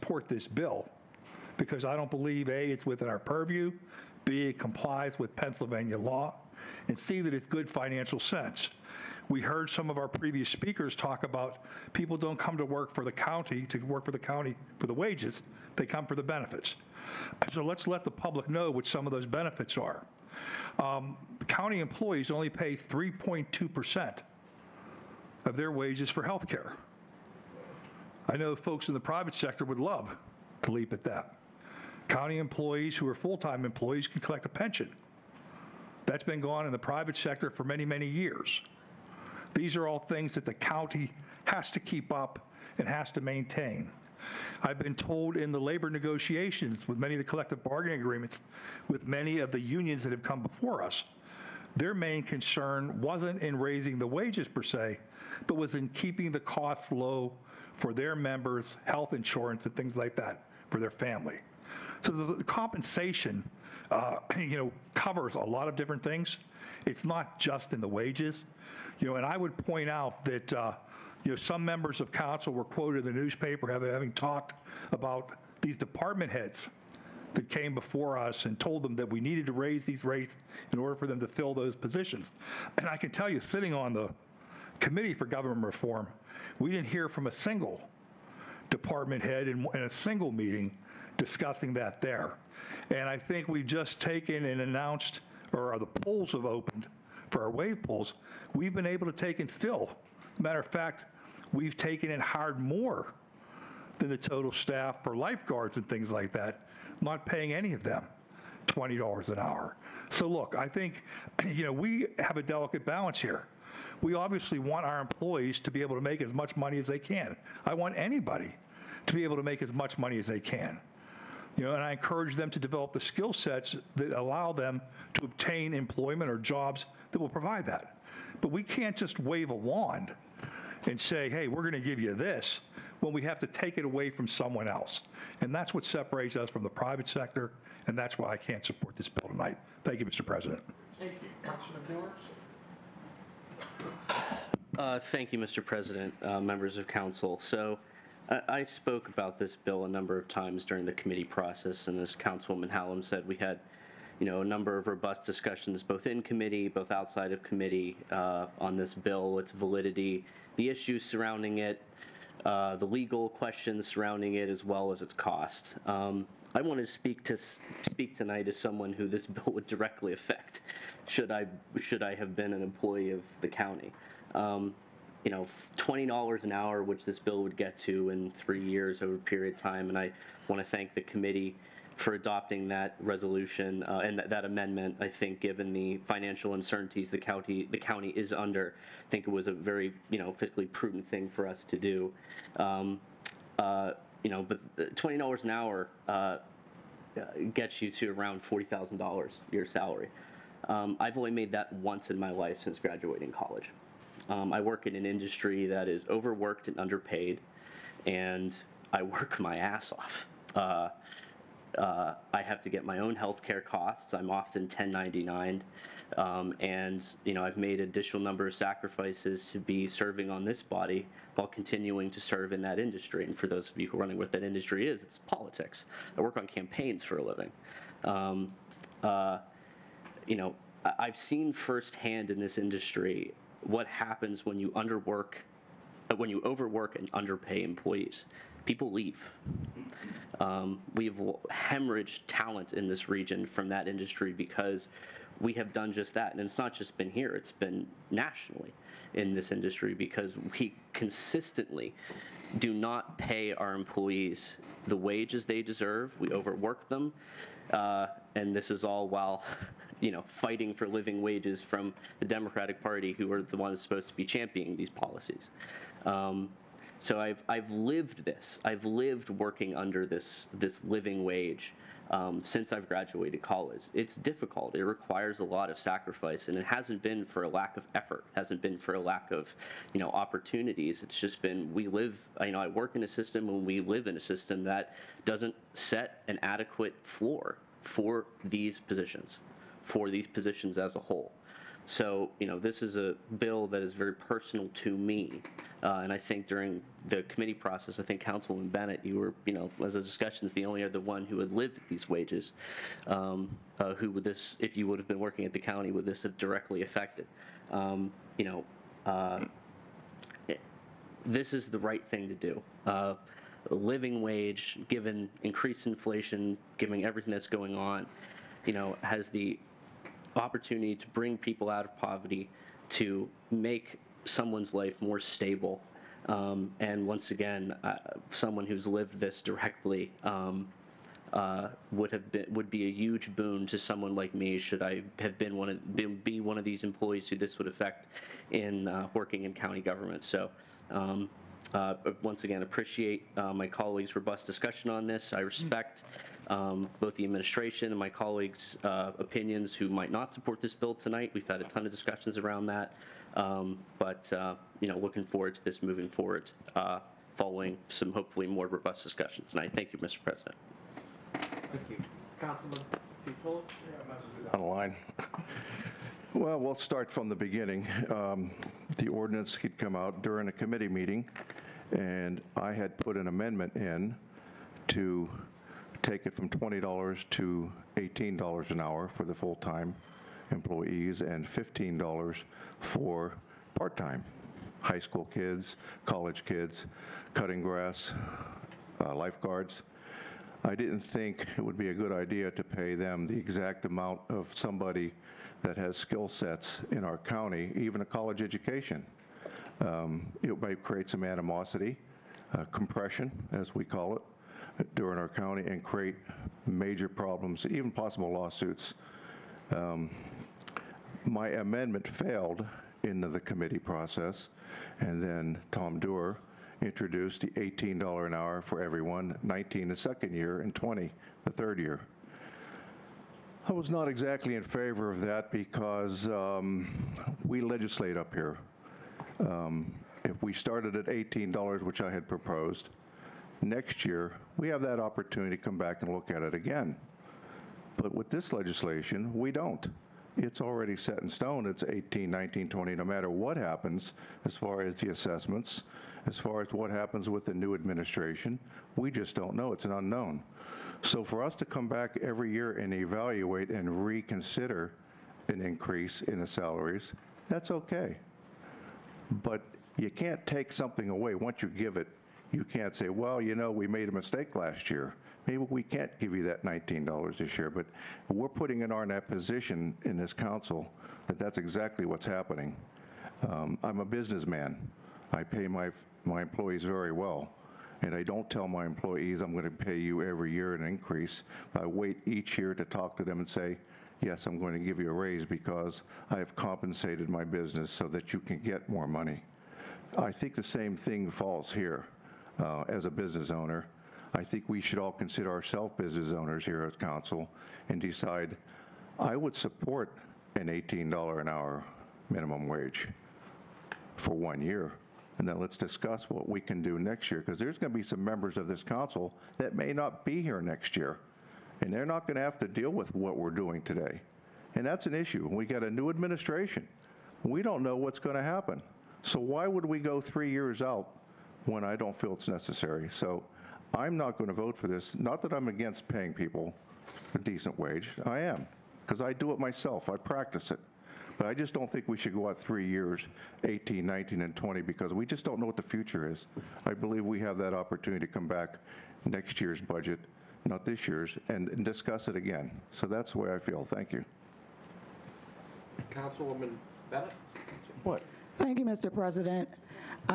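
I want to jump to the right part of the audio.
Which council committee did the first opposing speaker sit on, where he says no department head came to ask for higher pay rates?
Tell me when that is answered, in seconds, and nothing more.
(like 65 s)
85 s.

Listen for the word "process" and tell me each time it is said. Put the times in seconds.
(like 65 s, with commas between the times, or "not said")
151 s, 297 s, 413 s.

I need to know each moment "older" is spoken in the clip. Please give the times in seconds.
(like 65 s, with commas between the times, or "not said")
not said.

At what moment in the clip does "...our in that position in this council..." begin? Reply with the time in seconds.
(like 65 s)
468 s.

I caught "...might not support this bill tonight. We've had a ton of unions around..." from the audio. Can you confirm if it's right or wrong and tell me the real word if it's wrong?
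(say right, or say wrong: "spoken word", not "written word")
wrong: "discussions", not "unions".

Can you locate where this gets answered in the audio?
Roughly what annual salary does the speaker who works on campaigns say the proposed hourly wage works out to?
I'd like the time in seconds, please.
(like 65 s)
198 s.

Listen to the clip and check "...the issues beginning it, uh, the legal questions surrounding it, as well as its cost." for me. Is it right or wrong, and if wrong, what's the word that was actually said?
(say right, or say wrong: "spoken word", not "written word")
wrong: "surrounding", not "beginning".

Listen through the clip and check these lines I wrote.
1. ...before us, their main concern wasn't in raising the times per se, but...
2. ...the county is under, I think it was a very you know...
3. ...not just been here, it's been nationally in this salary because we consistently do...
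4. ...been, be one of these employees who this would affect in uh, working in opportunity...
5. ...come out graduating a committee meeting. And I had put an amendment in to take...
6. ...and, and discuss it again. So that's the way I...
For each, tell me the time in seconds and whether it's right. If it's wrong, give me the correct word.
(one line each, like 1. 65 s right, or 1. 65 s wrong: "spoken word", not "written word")
1. 50 s wrong: "wages", not "times"
2. 187 s right
3. 246 s wrong: "industry", not "salary"
4. 335 s wrong: "county", not "opportunity"
5. 369 s wrong: "during", not "graduating"
6. 541 s right.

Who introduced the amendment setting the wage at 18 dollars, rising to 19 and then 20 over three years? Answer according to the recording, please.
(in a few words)
Tom Duerr.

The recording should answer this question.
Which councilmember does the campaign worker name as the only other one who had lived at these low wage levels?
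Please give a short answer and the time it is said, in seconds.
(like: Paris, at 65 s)
Councilman Bennett, at 298 s.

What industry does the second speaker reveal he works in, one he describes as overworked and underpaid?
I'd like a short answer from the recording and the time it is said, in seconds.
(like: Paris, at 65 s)
politics, at 225 s.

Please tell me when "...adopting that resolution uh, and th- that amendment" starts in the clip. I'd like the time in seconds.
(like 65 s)
182 s.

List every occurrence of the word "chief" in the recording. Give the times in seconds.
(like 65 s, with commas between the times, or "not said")
not said.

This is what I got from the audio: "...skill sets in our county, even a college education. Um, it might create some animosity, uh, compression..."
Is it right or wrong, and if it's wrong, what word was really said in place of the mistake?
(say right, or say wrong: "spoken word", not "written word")
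right.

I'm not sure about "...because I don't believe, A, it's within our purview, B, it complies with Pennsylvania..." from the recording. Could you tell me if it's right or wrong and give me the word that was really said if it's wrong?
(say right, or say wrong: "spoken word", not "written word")
right.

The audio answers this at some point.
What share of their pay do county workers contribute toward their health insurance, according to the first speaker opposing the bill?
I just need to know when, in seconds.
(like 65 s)
22 s.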